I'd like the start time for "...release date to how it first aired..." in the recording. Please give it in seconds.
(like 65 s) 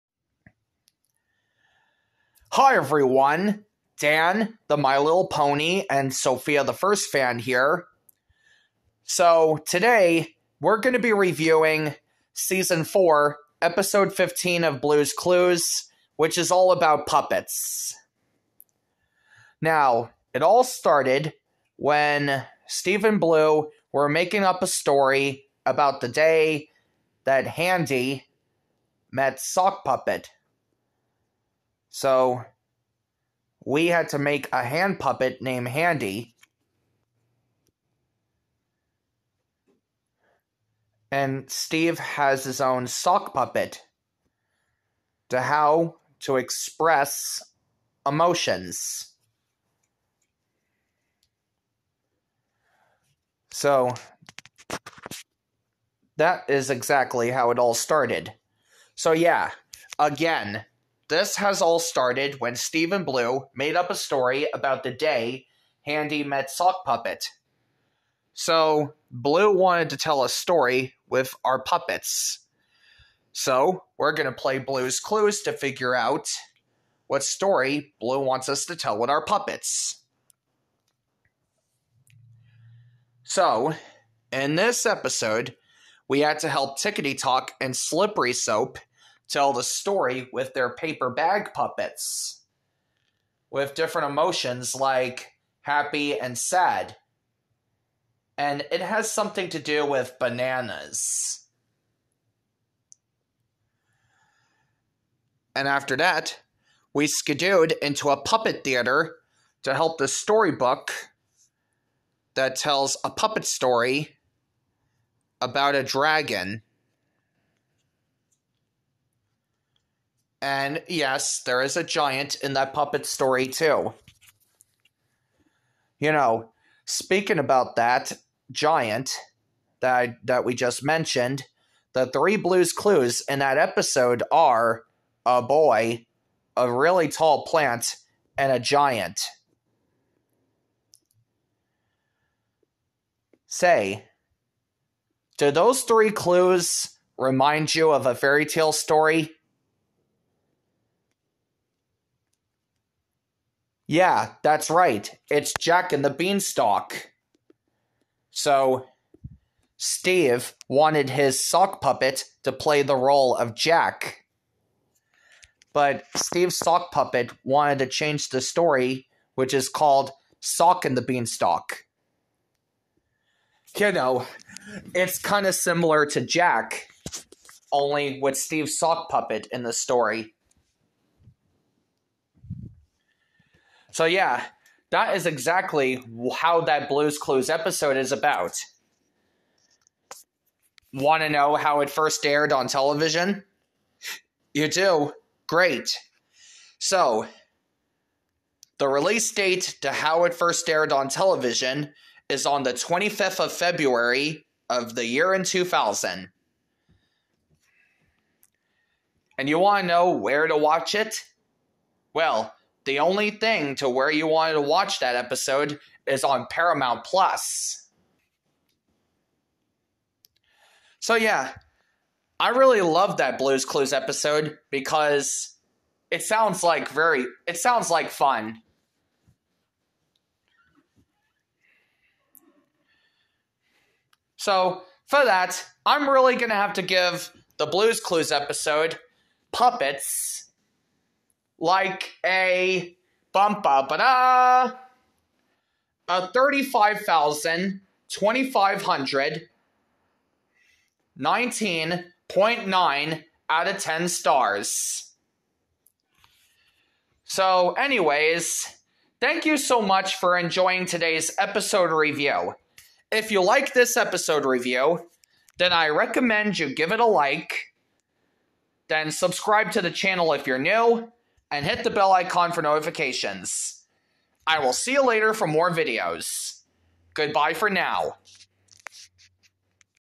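198 s.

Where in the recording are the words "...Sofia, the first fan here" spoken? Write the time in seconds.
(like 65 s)
6 s.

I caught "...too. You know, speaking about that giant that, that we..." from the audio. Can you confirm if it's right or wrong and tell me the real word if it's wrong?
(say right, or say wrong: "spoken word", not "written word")
right.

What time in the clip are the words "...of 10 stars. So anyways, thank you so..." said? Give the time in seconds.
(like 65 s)
253 s.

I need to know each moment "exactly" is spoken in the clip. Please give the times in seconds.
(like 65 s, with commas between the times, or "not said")
56 s, 185 s.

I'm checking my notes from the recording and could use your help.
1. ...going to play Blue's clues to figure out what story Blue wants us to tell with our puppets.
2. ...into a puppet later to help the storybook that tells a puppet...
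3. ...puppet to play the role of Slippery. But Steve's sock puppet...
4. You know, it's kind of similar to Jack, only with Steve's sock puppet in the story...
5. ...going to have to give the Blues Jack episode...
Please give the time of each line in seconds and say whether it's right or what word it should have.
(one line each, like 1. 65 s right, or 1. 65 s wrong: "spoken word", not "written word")
1. 74 s right
2. 107 s wrong: "theater", not "later"
3. 161 s wrong: "Jack", not "Slippery"
4. 173 s right
5. 236 s wrong: "Clues", not "Jack".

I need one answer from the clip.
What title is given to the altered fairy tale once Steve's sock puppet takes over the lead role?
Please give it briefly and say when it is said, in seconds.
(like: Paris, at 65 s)
Sock and the Beanstalk, at 170 s.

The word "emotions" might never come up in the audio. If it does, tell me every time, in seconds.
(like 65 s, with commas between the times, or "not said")
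48 s, 94 s.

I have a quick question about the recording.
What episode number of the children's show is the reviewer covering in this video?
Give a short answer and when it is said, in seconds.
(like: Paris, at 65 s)
15, at 13 s.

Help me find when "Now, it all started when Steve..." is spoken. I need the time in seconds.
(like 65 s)
19 s.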